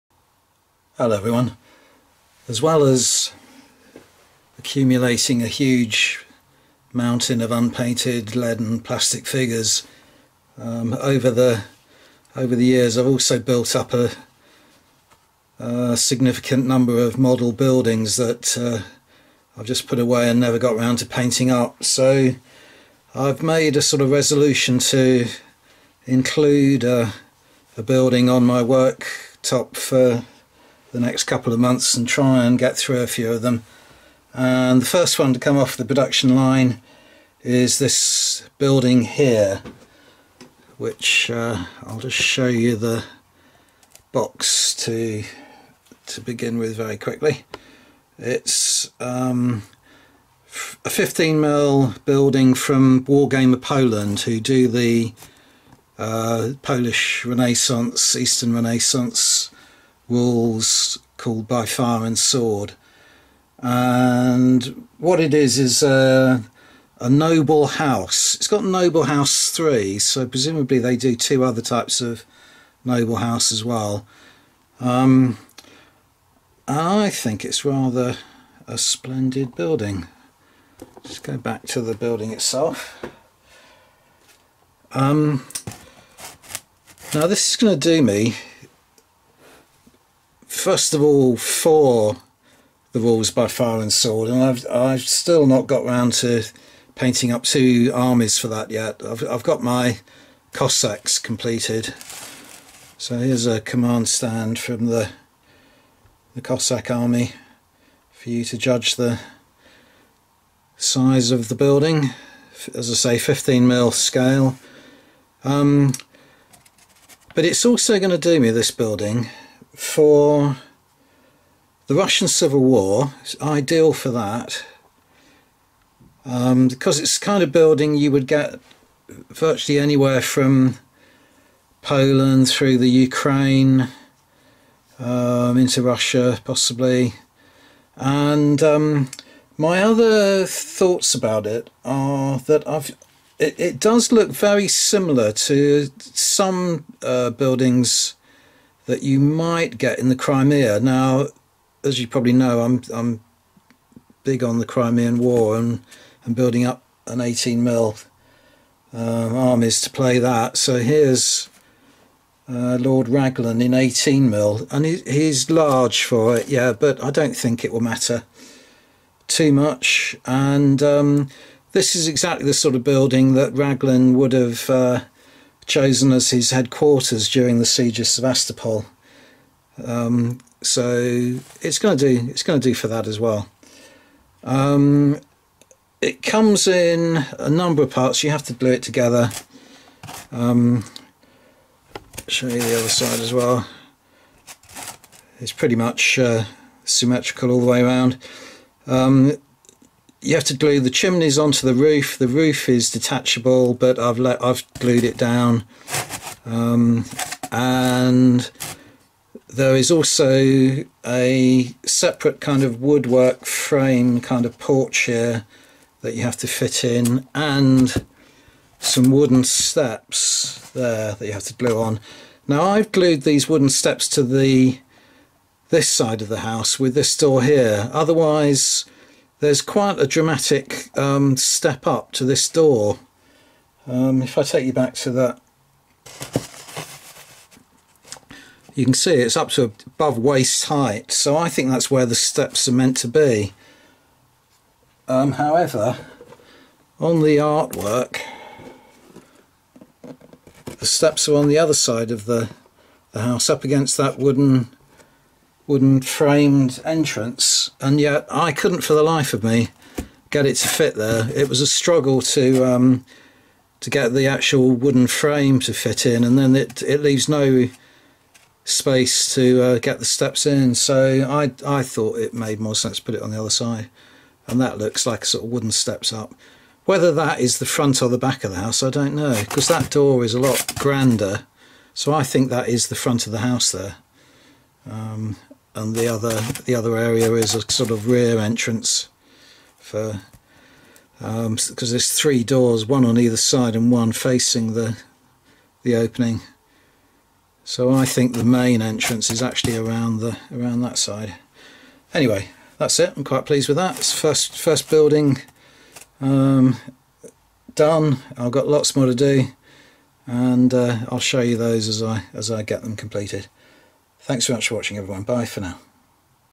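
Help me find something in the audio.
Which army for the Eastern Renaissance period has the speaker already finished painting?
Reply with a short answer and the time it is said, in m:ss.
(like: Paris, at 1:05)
Cossacks, at 1:40.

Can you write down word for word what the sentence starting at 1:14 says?
Um, I think it's rather a splendid building.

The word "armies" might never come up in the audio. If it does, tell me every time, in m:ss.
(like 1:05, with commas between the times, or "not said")
1:37, 2:39.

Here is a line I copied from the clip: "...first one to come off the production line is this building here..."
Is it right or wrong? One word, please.
right.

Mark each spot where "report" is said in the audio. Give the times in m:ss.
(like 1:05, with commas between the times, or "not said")
not said.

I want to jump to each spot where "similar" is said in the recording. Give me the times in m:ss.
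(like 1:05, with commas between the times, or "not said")
2:24.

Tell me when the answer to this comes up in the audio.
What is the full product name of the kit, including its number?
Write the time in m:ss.
1:08.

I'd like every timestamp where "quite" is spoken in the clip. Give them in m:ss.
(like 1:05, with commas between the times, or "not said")
3:49, 5:03.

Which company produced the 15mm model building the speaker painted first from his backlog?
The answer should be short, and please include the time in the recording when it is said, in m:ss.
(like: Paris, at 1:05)
Wargamer Poland, at 0:53.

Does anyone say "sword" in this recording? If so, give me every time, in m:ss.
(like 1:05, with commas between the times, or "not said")
1:02, 1:33.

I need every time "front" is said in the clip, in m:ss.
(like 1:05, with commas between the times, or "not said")
4:37, 4:42.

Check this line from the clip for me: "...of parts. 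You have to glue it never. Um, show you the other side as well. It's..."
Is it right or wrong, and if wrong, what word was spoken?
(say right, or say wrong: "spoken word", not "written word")
wrong: "together", not "never".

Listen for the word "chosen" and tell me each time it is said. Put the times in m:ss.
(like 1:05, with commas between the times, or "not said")
2:55.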